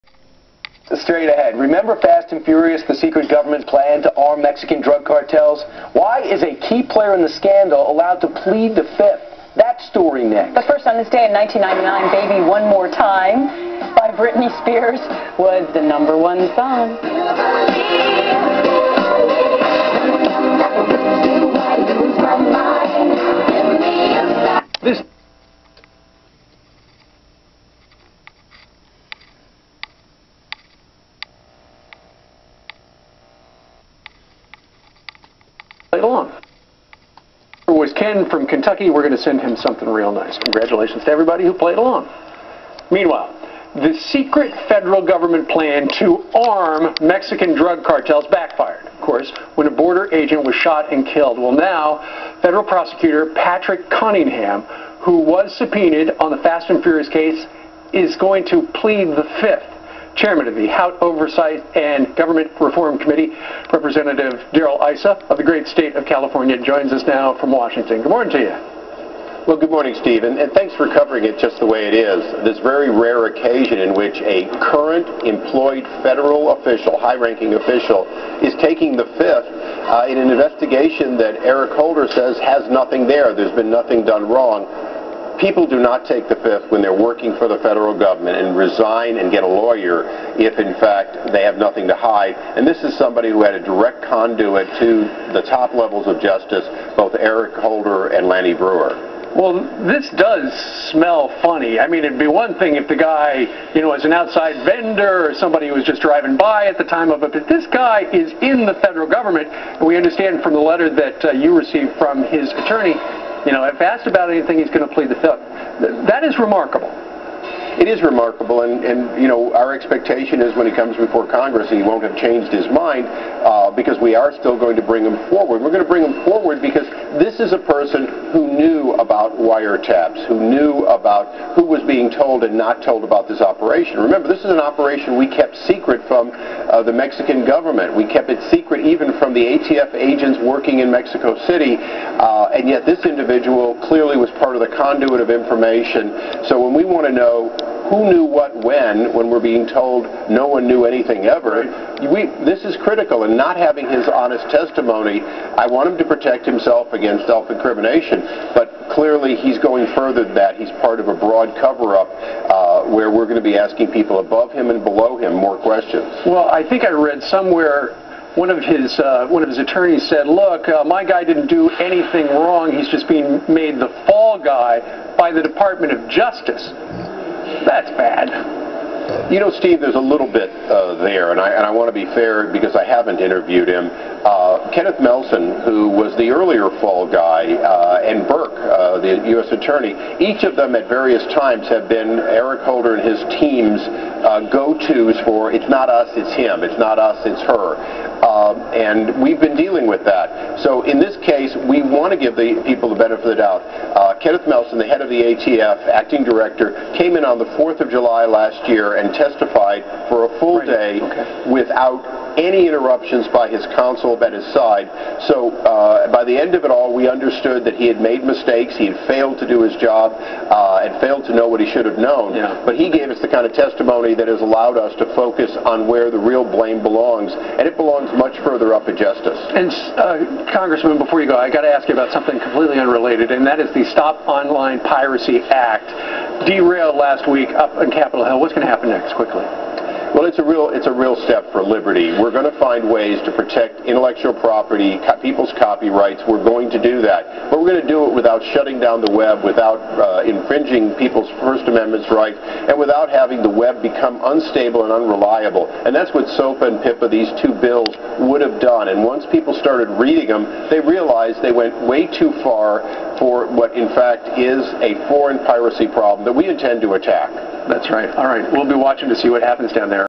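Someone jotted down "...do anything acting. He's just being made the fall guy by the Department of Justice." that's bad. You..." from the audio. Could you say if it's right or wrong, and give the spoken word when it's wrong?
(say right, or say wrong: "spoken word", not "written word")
wrong: "wrong", not "acting".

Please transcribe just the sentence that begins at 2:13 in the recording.
Remember, this is an operation we kept secret from uh, the Mexican government.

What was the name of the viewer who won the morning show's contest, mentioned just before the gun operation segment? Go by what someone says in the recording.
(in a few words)
Ken.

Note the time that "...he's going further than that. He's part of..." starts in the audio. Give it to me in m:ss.
2:39.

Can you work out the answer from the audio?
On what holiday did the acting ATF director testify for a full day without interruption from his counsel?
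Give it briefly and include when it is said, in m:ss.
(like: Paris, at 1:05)
4th of July, at 3:27.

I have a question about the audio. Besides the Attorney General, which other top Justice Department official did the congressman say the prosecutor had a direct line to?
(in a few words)
Lanny Breuer.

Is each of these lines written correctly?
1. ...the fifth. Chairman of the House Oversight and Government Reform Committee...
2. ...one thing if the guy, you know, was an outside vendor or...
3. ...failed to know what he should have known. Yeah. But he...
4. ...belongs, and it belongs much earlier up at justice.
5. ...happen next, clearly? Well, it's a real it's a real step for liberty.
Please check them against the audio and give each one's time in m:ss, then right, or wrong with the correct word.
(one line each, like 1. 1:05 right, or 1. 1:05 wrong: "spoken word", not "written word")
1. 0:59 right
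2. 1:42 right
3. 3:41 right
4. 3:46 wrong: "further", not "earlier"
5. 3:58 wrong: "quickly", not "clearly".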